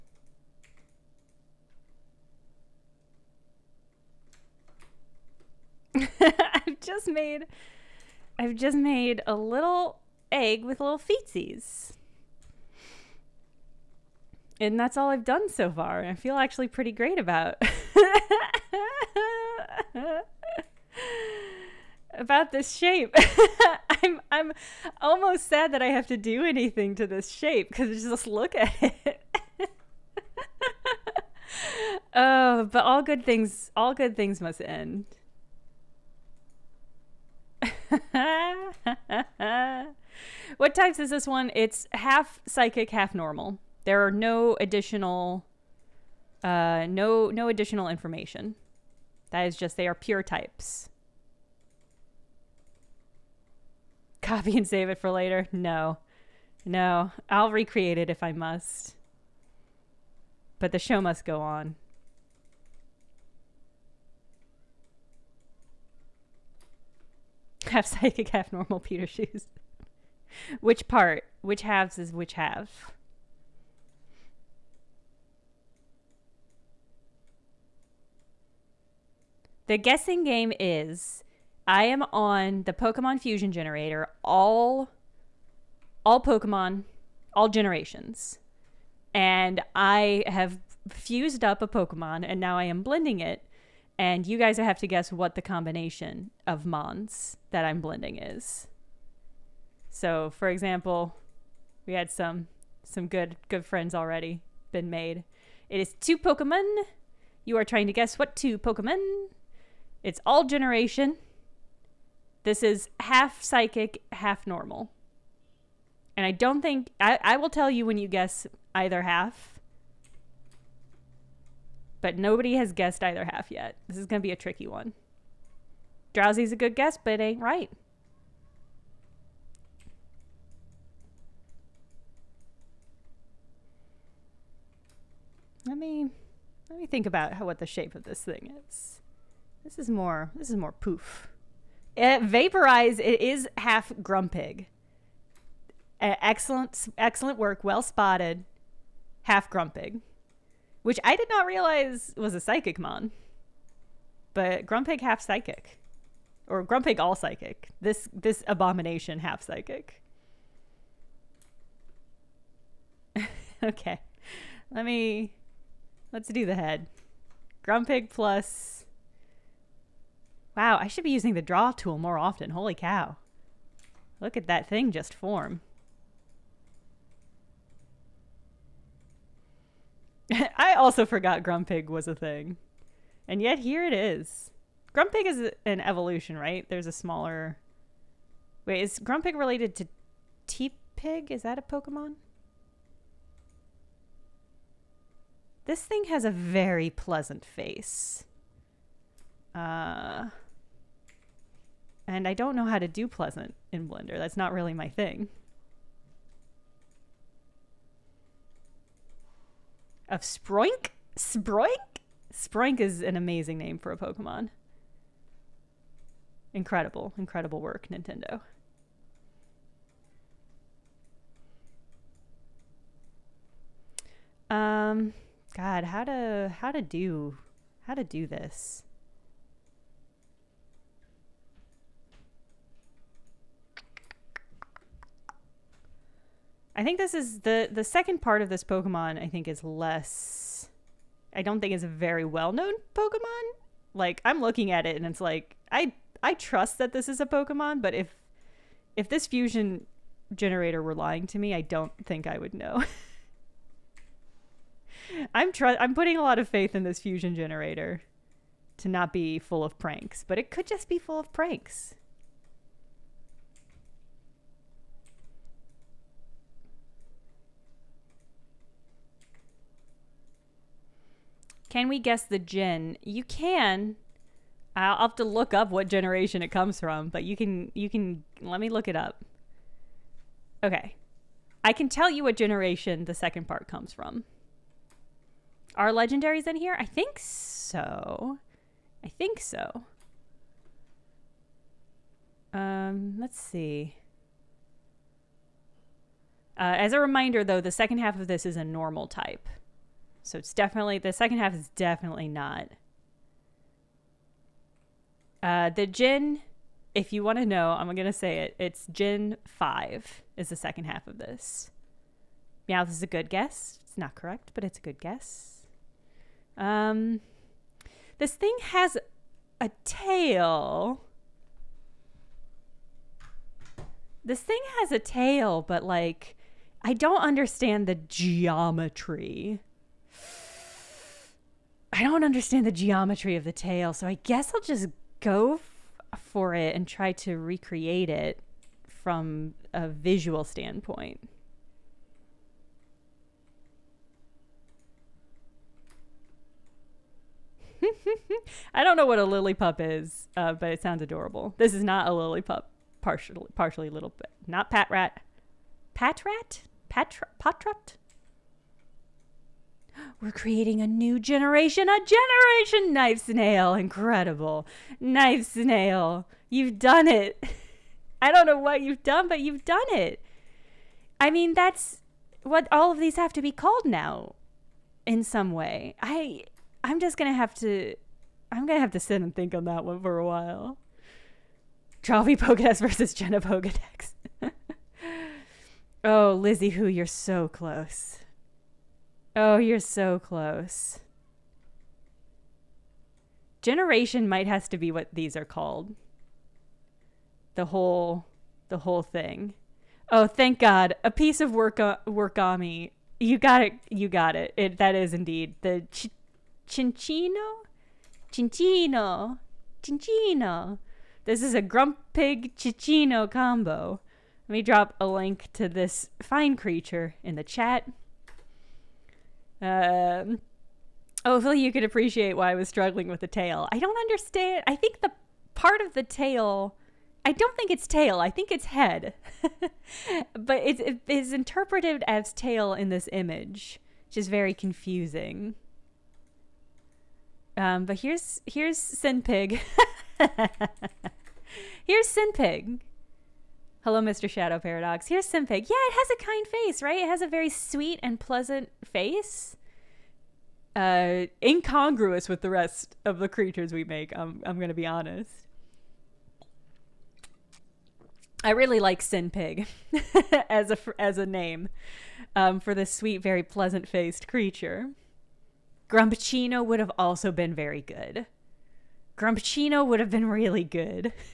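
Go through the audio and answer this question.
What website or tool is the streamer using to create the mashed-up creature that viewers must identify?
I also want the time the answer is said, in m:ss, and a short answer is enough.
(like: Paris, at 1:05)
Pokemon Fusion Generator, at 1:22.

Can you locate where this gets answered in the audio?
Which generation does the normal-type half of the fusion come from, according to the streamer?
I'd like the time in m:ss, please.
5:08.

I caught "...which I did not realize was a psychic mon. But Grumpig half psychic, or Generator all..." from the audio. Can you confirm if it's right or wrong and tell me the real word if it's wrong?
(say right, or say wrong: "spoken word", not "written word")
wrong: "Grumpig", not "Generator".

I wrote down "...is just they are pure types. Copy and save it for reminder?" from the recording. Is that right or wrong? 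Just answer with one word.
wrong.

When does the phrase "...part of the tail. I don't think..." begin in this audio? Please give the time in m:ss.
7:05.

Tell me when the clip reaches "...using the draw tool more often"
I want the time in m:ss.
2:51.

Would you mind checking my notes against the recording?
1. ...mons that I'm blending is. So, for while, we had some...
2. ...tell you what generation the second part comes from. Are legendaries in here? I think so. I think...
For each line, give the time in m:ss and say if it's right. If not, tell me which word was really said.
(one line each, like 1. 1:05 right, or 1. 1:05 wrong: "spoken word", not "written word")
1. 1:36 wrong: "example", not "while"
2. 4:41 right.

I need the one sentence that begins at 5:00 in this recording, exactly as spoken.
So it's definitely the second half is definitely not.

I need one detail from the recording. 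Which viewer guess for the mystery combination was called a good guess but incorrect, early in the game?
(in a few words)
Drowsy.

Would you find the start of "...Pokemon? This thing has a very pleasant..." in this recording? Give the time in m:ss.
3:11.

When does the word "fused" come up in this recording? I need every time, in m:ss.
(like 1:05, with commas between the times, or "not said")
1:30.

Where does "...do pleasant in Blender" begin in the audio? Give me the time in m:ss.
3:22.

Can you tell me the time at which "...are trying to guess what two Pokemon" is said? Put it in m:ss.
1:47.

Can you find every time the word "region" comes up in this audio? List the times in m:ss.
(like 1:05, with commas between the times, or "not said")
not said.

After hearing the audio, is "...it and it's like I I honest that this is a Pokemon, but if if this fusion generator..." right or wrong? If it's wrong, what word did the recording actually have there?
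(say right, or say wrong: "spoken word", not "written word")
wrong: "trust", not "honest".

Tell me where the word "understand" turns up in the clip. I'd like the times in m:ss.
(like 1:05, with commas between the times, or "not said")
5:27, 5:32, 7:03.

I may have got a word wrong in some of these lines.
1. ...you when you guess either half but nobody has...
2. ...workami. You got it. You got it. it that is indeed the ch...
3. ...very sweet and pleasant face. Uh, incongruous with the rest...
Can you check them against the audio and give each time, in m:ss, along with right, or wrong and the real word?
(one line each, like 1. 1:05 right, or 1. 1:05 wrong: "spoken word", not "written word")
1. 1:57 right
2. 6:42 right
3. 7:27 right.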